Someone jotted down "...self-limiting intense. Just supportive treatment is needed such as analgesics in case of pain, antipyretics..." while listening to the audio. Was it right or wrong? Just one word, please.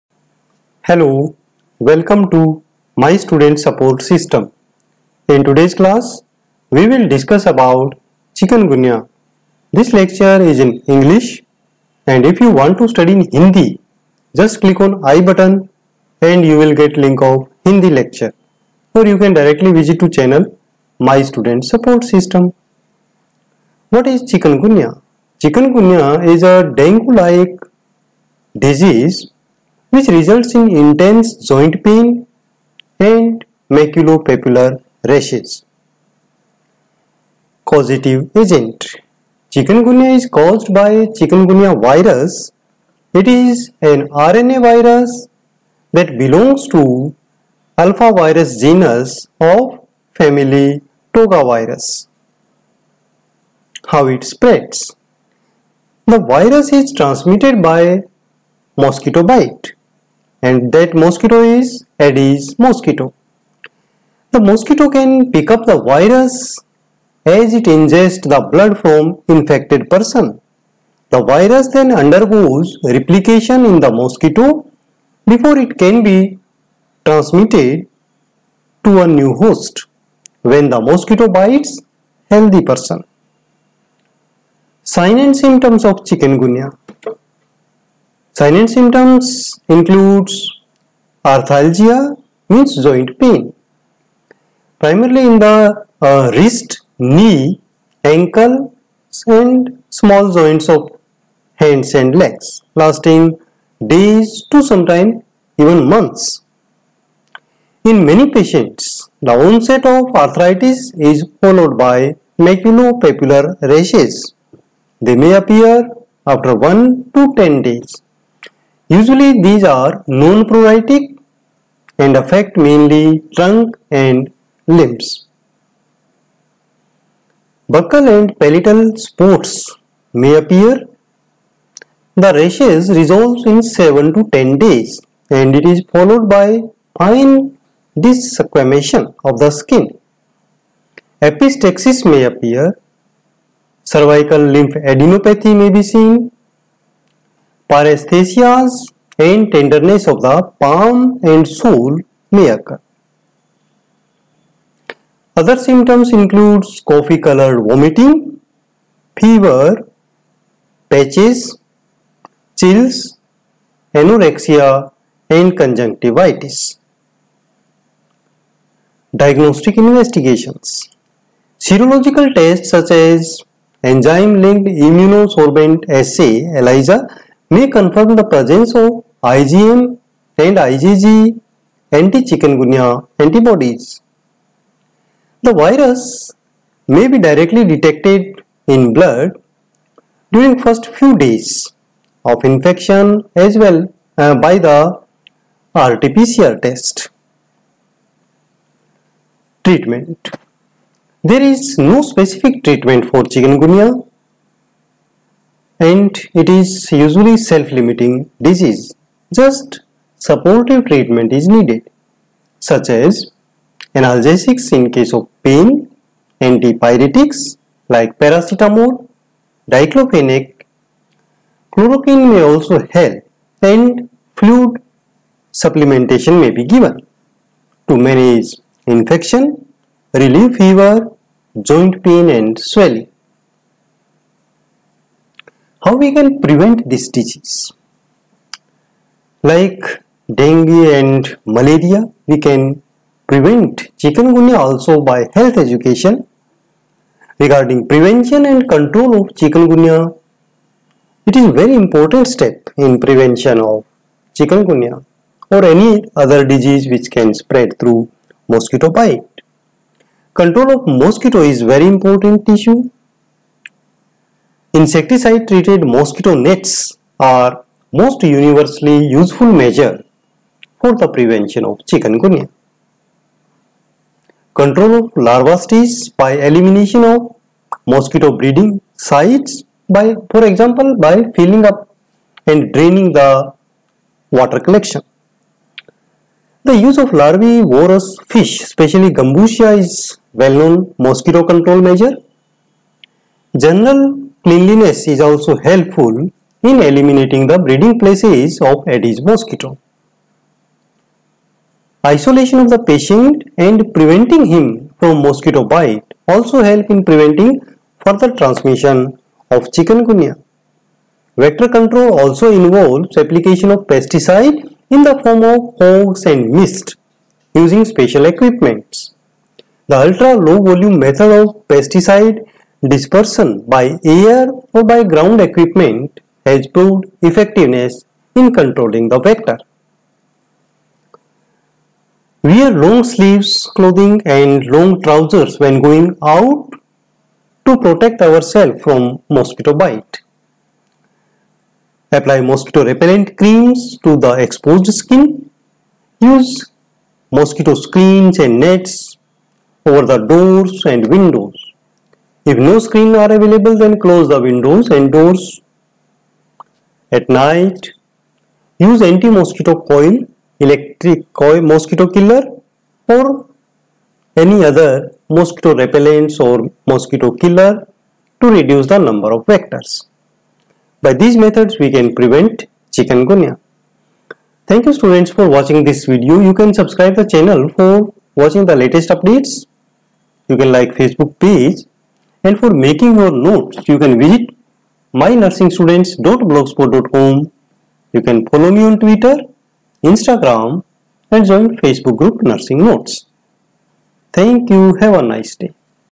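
wrong.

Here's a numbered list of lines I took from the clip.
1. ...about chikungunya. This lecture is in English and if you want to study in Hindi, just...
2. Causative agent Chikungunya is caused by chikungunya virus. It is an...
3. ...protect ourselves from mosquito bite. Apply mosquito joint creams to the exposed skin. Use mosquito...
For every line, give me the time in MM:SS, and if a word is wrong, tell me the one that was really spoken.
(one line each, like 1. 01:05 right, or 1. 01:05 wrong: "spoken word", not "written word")
1. 00:07 right
2. 00:37 right
3. 05:37 wrong: "repellent", not "joint".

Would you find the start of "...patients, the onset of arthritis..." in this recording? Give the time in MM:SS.
01:48.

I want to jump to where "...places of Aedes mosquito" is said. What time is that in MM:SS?
04:57.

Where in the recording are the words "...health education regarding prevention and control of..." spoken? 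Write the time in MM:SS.
04:05.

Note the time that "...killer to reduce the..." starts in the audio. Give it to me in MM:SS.
06:07.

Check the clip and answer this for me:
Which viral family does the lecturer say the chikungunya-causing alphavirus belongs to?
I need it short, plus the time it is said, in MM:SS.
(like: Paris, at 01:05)
Togavirus, at 00:51.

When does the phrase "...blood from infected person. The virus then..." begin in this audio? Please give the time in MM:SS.
01:08.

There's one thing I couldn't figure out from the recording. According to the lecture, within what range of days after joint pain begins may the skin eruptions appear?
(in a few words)
1 to 10 days.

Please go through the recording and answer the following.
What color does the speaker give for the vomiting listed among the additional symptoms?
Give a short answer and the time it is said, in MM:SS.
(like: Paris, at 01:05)
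Coffee colored, at 02:36.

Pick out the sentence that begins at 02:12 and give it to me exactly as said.
The rashes resolves in 7 to 10 days and it is followed by fine desquamation of the skin.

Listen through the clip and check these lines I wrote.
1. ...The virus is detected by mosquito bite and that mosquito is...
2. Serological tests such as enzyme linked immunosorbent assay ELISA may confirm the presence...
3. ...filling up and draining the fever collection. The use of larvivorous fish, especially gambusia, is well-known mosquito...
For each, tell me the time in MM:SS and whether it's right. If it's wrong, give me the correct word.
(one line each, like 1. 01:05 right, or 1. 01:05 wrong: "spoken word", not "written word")
1. 00:56 wrong: "transmitted", not "detected"
2. 02:51 right
3. 04:41 wrong: "water", not "fever".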